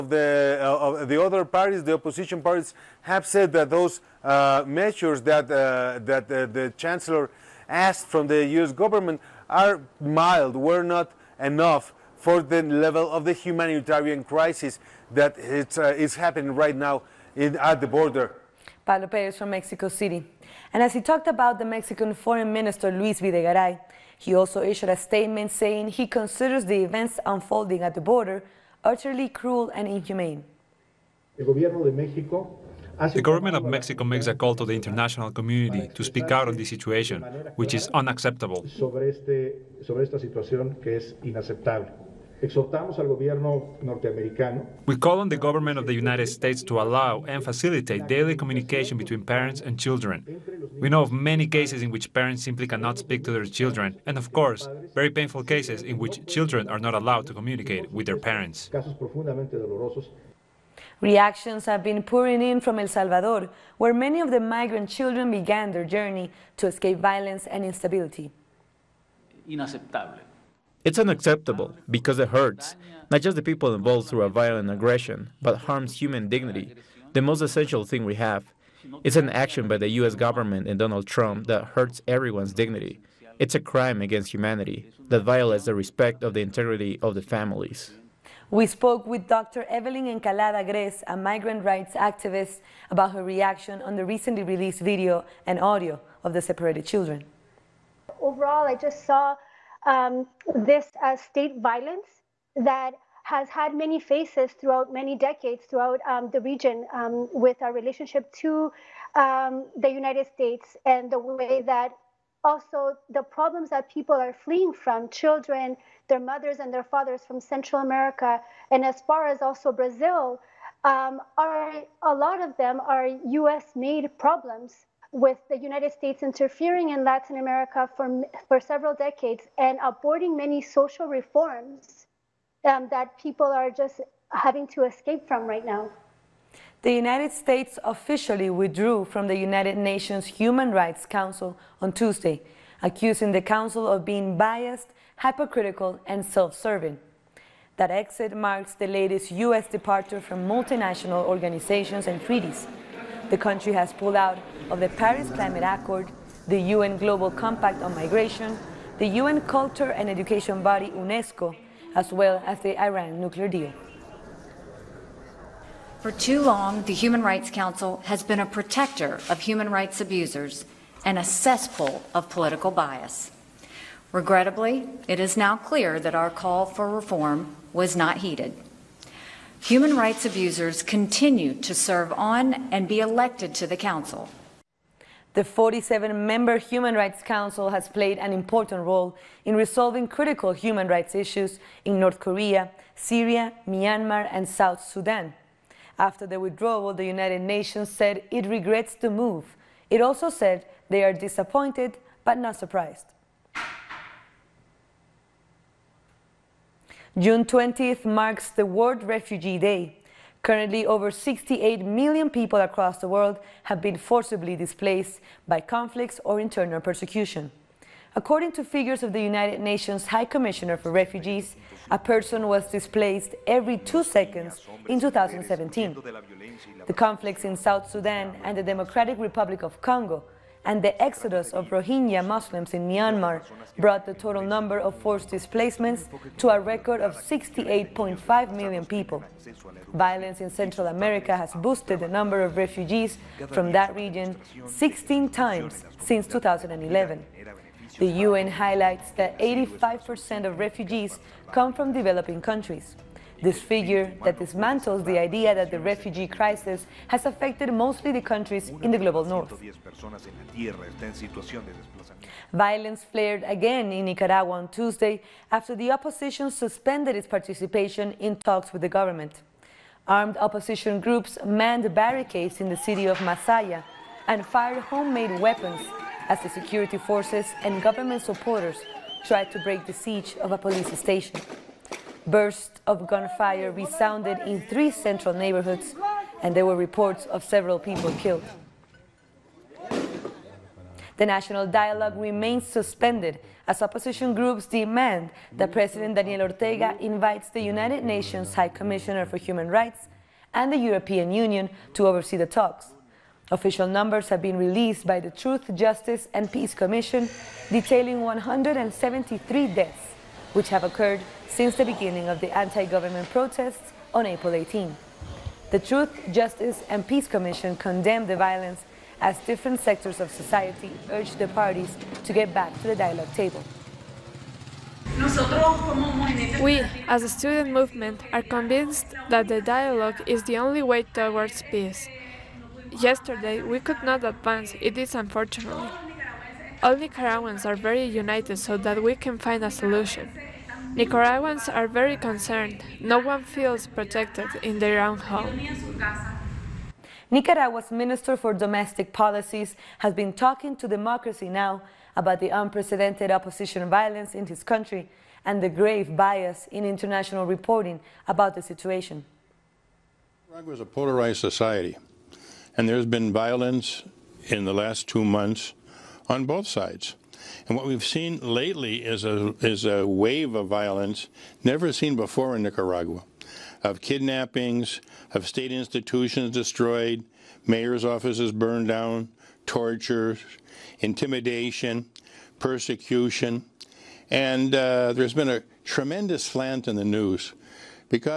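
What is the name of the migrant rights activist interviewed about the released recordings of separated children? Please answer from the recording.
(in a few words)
Evelyn Encalada Grez.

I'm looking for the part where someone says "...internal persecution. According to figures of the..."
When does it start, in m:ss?
3:36.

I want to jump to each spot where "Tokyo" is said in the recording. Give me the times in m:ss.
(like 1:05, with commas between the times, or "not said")
not said.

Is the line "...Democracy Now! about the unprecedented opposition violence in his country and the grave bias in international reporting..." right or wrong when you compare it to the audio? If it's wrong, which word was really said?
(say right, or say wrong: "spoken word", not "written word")
right.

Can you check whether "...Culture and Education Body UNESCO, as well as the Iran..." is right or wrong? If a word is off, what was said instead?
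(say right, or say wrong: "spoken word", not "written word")
right.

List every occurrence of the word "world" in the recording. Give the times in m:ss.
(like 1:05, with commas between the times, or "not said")
3:28, 3:33.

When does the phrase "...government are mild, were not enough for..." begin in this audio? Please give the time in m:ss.
0:08.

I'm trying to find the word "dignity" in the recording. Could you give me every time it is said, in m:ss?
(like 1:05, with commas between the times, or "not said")
1:16, 1:22.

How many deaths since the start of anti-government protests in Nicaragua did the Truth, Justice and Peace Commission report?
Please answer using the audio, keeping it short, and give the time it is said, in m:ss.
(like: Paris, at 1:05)
173, at 5:08.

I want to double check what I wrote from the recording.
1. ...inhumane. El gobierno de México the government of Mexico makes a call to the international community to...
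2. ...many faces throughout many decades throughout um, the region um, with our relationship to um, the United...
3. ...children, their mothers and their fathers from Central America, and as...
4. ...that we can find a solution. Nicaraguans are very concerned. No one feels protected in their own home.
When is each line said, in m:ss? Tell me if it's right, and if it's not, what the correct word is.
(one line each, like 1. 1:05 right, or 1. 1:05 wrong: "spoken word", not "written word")
1. 0:29 right
2. 1:43 right
3. 1:55 right
4. 5:38 right.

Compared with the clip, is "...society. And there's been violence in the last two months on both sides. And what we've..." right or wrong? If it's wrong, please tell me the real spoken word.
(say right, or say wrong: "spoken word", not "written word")
right.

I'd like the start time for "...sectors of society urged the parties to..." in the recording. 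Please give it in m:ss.
5:19.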